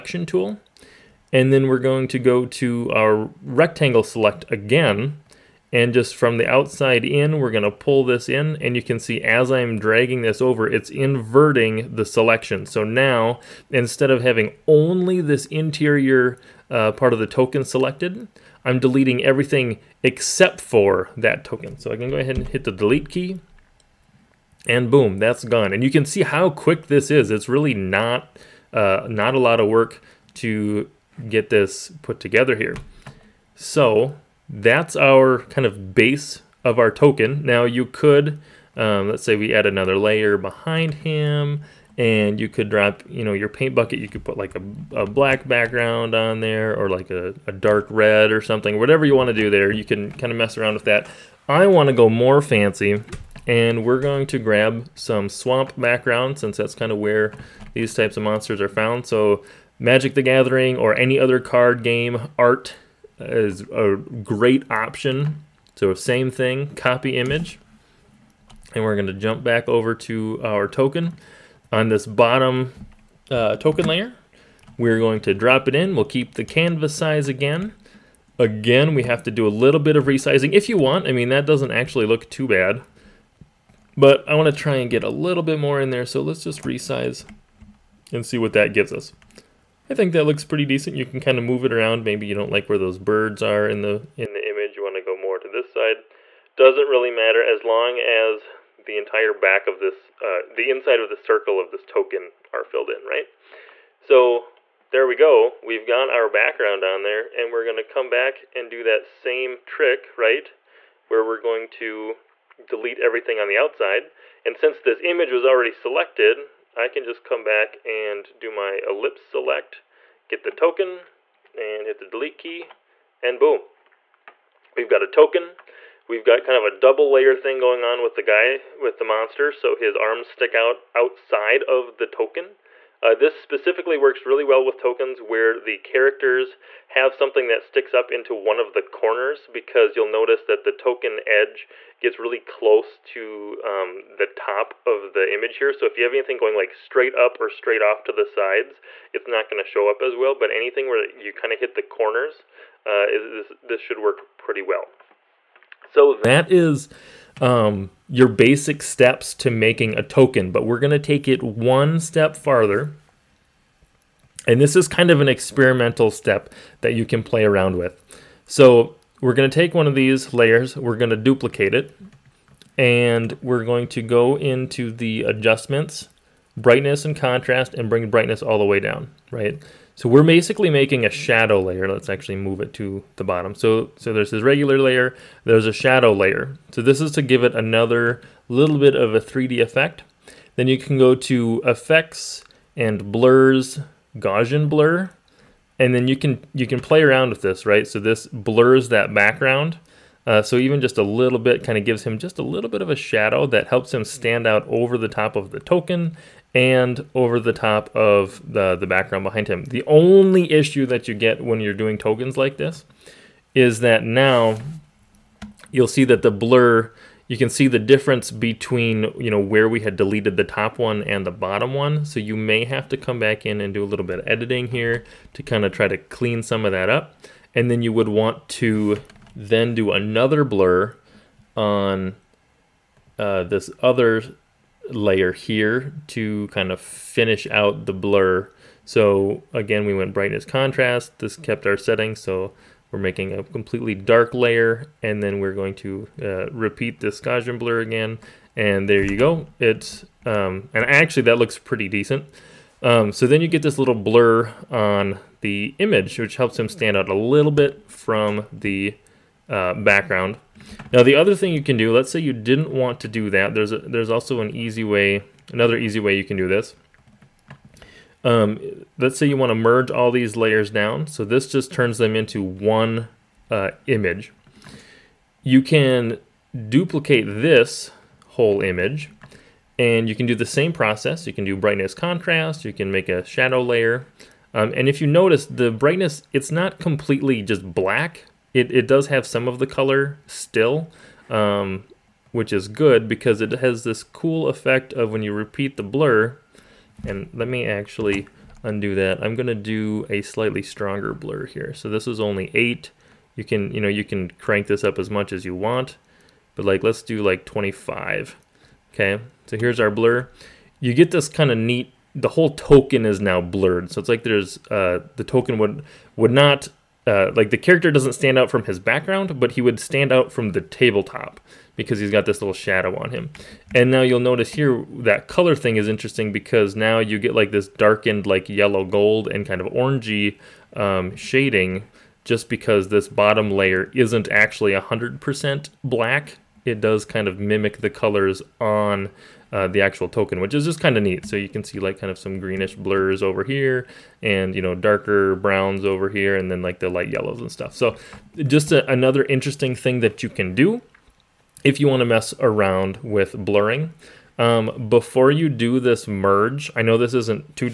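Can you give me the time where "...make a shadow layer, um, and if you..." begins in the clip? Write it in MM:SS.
04:42.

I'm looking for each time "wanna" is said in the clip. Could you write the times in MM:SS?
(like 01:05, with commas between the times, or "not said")
01:24.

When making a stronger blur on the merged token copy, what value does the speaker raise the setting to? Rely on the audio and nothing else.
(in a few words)
25.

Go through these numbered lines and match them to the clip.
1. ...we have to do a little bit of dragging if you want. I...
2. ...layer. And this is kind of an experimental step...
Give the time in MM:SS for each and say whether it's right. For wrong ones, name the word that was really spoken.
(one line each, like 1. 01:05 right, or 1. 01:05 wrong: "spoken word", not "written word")
1. 01:18 wrong: "resizing", not "dragging"
2. 02:42 wrong: "farther", not "layer".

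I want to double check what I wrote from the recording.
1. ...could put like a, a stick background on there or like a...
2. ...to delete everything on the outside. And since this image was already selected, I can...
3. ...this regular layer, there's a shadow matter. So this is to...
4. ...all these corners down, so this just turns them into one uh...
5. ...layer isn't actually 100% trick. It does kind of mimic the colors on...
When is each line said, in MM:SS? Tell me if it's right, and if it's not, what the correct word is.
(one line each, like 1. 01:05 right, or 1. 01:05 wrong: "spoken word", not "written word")
1. 00:44 wrong: "black", not "stick"
2. 01:51 right
3. 03:04 wrong: "layer", not "matter"
4. 04:29 wrong: "layers", not "corners"
5. 05:33 wrong: "black", not "trick".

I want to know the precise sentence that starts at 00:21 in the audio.
So I can go ahead and hit the delete key and boom, that's gone.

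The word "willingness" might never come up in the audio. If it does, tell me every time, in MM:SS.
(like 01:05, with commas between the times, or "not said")
not said.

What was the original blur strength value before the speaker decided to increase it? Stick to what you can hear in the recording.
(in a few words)
8.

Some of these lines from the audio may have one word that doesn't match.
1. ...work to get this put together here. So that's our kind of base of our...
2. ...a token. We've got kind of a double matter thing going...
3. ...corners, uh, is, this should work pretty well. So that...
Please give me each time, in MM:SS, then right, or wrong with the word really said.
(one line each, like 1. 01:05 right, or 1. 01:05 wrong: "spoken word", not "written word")
1. 00:29 right
2. 02:05 wrong: "layer", not "matter"
3. 02:31 right.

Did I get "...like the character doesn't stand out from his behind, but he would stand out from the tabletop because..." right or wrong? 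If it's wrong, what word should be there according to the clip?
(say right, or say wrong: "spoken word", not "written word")
wrong: "background", not "behind".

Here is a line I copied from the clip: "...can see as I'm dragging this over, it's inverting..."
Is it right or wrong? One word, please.
right.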